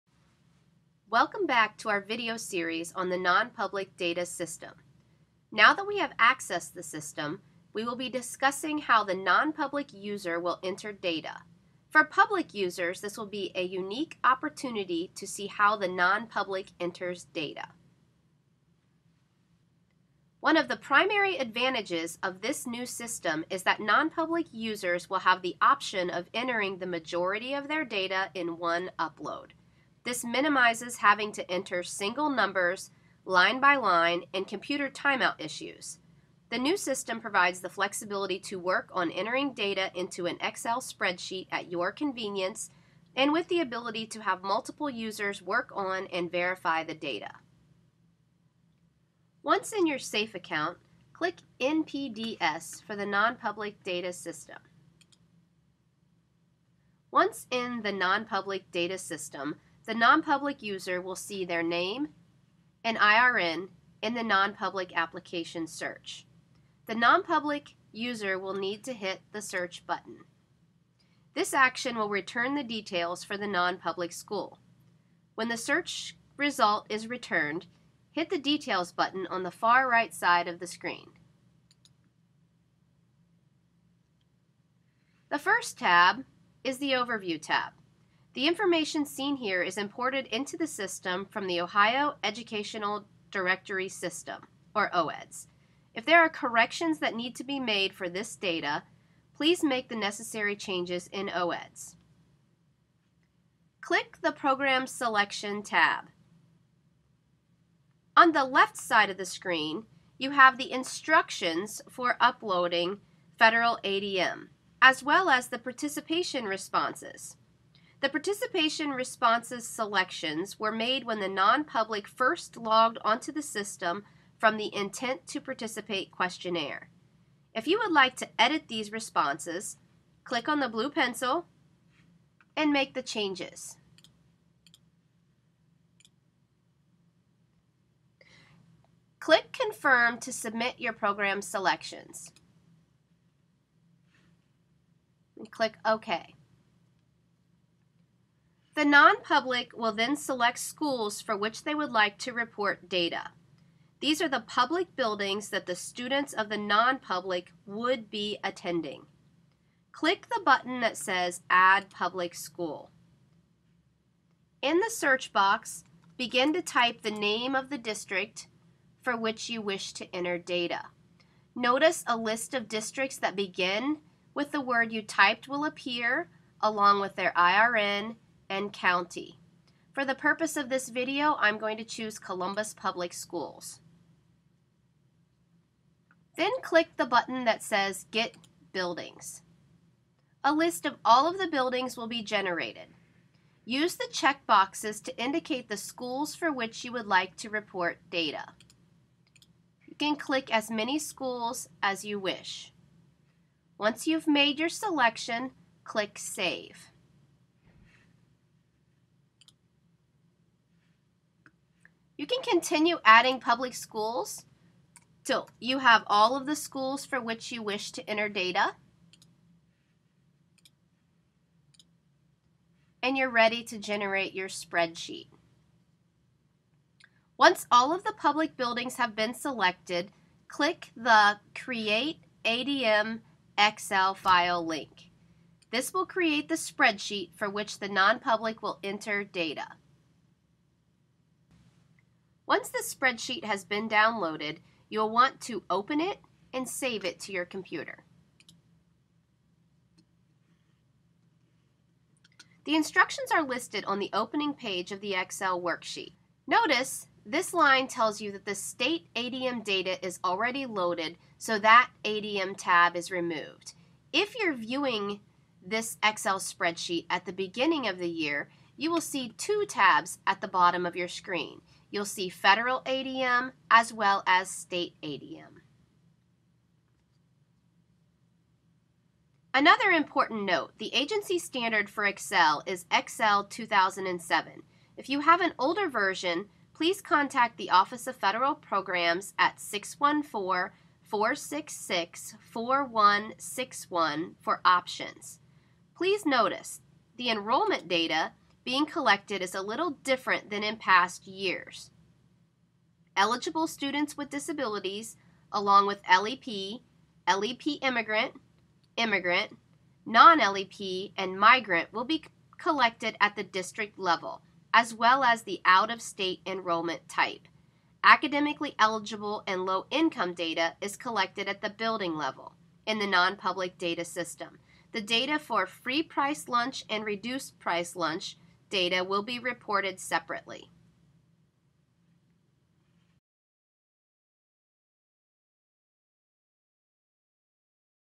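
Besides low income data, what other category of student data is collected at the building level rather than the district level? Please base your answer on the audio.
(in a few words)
Academically eligible.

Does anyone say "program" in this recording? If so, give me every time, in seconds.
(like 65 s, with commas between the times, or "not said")
104 s, 140 s, 288 s.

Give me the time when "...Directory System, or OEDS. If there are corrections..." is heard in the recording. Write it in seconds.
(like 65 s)
93 s.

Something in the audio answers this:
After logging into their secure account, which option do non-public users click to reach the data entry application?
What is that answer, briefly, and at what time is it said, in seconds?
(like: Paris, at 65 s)
NPDS, at 51 s.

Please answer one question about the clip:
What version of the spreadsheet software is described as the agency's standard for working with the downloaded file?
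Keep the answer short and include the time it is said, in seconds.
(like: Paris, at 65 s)
Excel 2007, at 282 s.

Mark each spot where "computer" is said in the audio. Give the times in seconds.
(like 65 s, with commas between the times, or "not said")
34 s, 247 s.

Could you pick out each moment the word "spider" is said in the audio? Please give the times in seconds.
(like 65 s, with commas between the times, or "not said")
not said.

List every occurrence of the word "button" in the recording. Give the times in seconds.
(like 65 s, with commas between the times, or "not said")
69 s, 78 s, 160 s, 187 s.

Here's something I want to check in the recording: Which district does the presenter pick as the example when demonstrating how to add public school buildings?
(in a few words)
Columbus Public Schools.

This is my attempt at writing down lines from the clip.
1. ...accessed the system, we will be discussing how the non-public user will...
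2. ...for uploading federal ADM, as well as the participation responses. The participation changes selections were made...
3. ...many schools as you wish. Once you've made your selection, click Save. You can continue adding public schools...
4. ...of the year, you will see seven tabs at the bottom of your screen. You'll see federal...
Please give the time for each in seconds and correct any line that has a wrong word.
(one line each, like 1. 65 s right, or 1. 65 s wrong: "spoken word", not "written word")
1. 6 s right
2. 111 s wrong: "responses", not "changes"
3. 200 s right
4. 267 s wrong: "two", not "seven".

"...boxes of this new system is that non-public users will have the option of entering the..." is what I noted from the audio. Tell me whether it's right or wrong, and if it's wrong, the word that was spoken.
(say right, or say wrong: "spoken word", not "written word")
wrong: "advantages", not "boxes".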